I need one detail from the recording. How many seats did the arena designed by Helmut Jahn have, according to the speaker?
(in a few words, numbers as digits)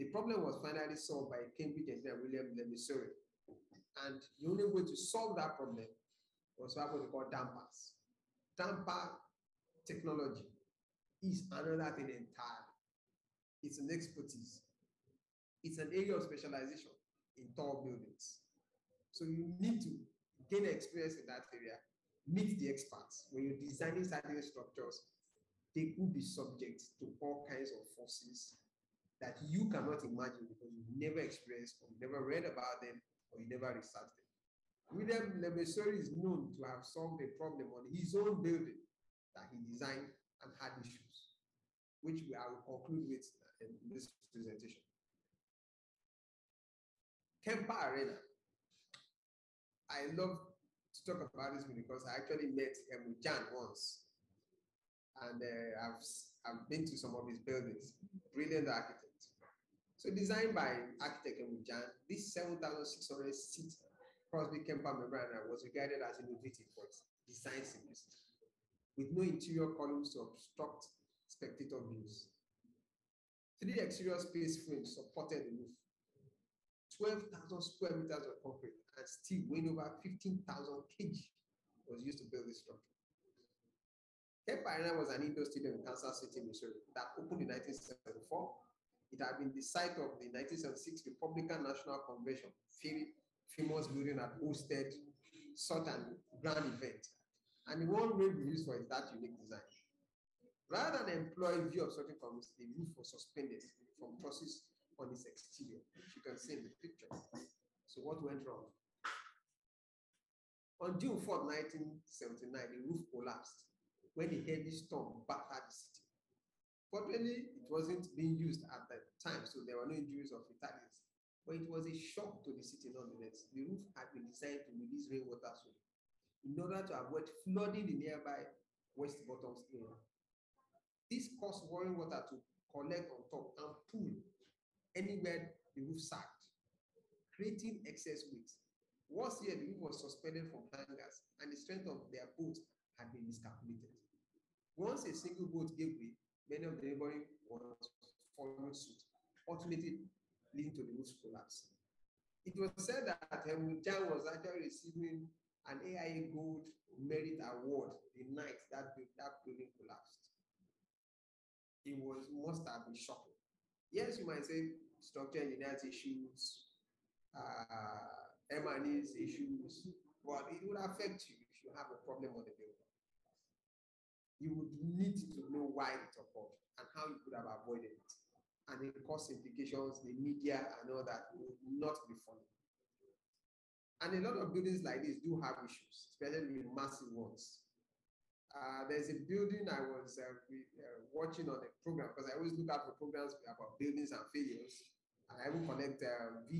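7,600.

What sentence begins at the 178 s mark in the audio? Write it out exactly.
And it cost implications, the media and all that would not be funny.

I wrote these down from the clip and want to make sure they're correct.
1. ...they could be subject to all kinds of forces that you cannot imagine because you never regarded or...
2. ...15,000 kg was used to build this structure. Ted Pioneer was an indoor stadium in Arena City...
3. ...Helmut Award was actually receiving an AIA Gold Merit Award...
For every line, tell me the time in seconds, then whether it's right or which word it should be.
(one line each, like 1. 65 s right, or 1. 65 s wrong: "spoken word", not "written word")
1. 25 s wrong: "experienced", not "regarded"
2. 80 s wrong: "Kansas", not "Arena"
3. 153 s wrong: "Jahn", not "Award".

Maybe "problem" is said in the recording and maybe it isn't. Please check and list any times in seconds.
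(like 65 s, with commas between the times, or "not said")
0 s, 5 s, 37 s, 171 s.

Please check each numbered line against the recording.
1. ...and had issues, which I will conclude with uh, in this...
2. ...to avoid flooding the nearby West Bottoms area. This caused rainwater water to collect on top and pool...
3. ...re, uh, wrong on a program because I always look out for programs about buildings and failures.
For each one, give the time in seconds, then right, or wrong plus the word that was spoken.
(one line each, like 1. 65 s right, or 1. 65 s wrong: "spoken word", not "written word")
1. 40 s right
2. 126 s right
3. 190 s wrong: "watching", not "wrong".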